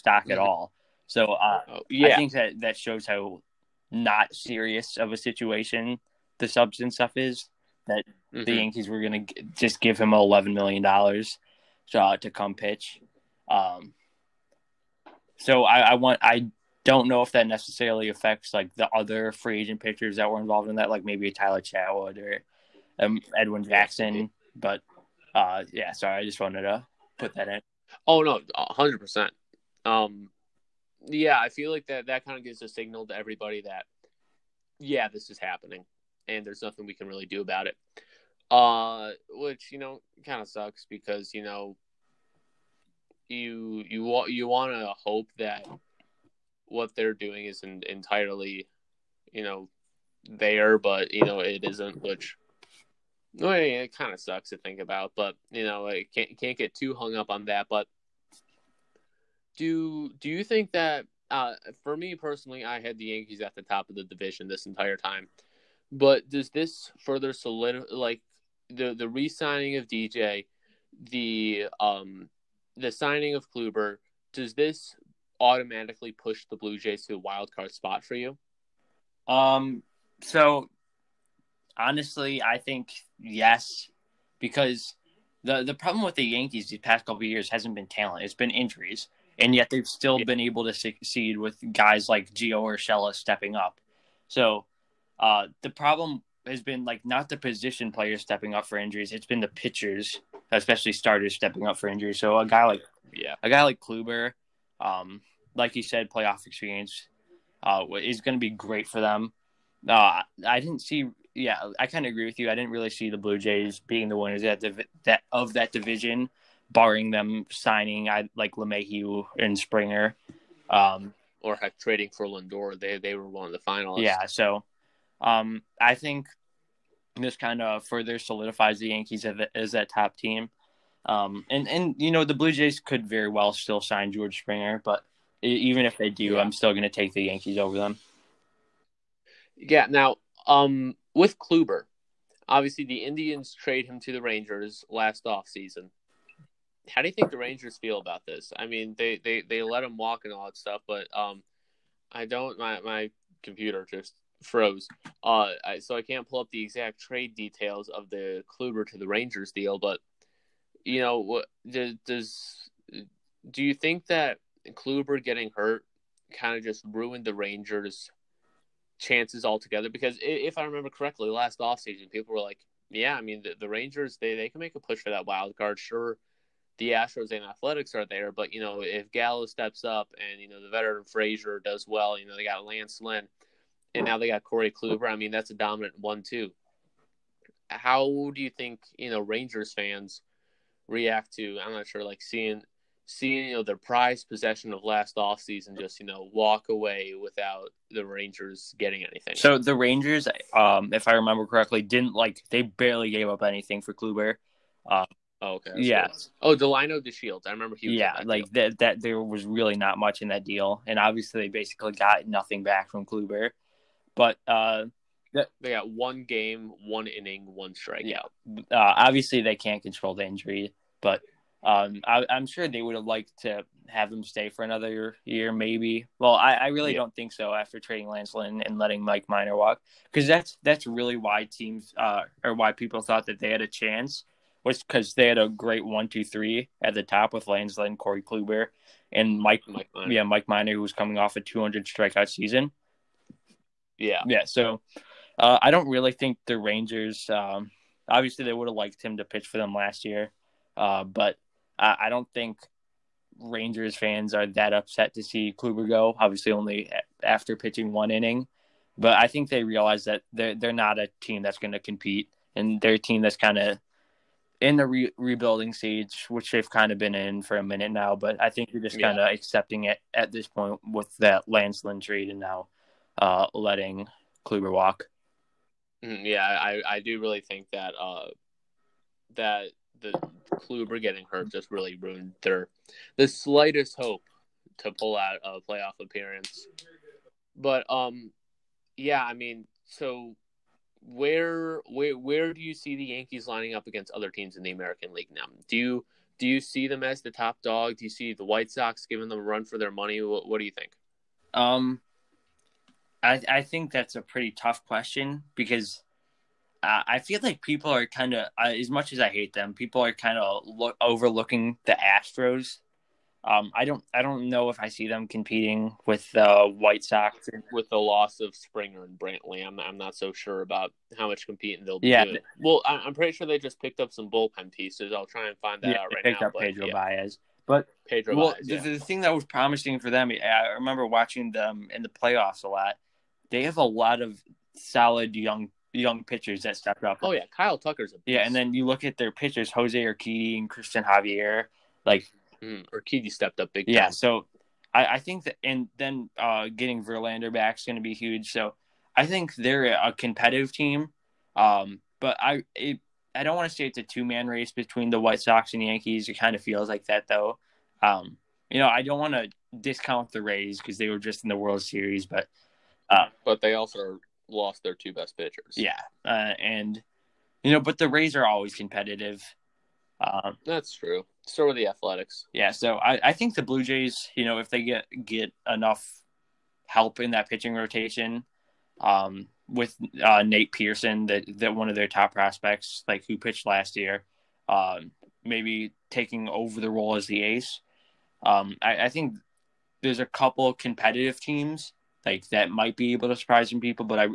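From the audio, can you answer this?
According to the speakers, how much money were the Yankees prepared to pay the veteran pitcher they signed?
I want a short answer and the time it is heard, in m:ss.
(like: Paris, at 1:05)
$11 million, at 0:10.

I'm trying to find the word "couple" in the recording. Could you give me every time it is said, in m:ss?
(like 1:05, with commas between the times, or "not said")
1:27, 6:30.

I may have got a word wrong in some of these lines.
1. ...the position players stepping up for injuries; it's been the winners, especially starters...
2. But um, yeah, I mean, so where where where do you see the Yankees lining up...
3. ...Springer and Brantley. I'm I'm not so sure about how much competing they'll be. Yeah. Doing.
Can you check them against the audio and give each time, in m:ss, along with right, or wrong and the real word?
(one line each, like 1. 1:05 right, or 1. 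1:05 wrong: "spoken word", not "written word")
1. 1:37 wrong: "pitchers", not "winners"
2. 4:47 right
3. 5:18 right.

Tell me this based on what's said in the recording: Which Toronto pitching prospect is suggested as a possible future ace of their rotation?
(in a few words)
Nate Pearson.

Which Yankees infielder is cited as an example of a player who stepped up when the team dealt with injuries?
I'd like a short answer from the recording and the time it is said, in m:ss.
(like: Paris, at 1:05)
Gio Urshela, at 1:32.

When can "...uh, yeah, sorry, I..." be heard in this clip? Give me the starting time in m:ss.
0:25.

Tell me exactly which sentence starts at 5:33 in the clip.
They have a lot of solid young young pitchers that stepped up.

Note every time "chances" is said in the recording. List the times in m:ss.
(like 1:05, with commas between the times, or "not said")
2:48, 3:53.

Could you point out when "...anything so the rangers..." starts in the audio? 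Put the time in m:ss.
3:19.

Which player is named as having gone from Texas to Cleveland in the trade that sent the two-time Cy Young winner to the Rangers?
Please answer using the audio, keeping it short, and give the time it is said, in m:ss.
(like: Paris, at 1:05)
Delino DeShields, at 3:26.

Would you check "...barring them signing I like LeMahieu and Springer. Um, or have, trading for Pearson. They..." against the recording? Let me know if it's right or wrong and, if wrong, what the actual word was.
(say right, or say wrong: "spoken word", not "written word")
wrong: "Lindor", not "Pearson".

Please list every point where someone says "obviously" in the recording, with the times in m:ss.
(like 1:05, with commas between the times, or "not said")
2:22, 3:30, 3:38, 4:08, 4:16.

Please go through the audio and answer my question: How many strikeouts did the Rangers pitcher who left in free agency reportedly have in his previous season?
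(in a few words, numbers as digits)
200.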